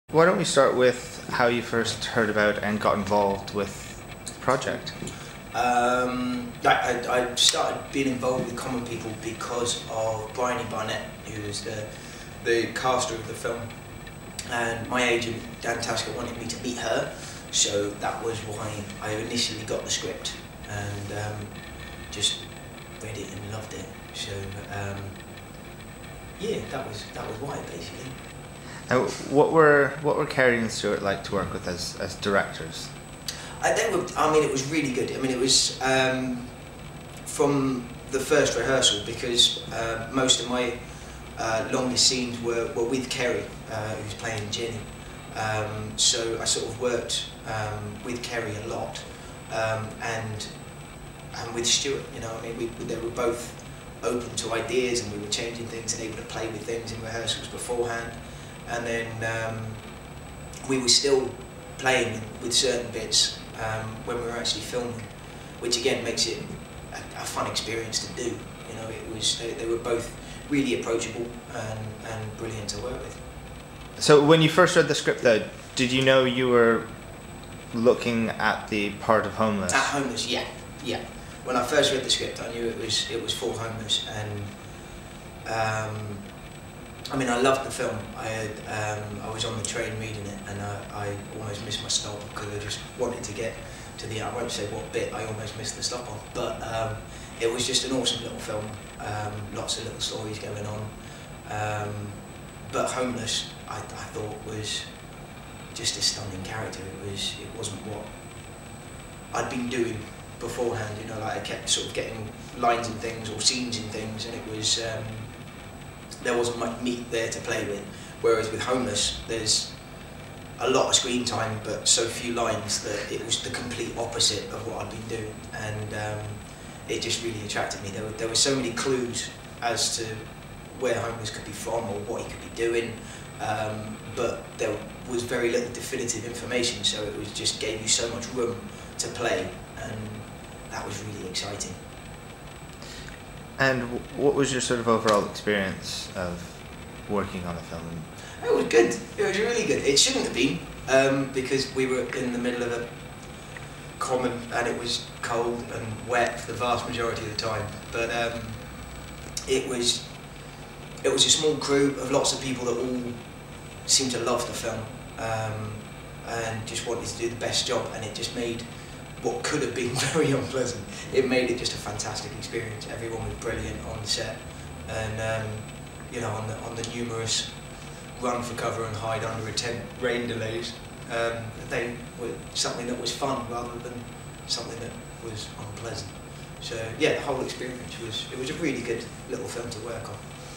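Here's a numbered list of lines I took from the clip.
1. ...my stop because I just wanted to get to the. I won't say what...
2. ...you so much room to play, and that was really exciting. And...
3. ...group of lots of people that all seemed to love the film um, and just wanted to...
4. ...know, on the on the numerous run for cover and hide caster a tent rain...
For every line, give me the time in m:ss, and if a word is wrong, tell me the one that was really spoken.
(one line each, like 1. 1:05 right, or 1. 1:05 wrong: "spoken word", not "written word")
1. 1:31 right
2. 2:17 right
3. 2:41 right
4. 2:56 wrong: "under", not "caster".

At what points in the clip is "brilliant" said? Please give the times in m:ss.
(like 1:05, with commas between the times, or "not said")
1:12, 2:53.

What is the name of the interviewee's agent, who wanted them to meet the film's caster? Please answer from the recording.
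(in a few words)
Dan Tasker.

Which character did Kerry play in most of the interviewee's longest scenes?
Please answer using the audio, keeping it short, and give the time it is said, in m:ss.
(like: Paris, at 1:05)
Ginny, at 0:44.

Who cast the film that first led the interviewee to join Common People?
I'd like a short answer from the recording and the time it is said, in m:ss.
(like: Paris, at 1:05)
Bryony Barnett, at 0:10.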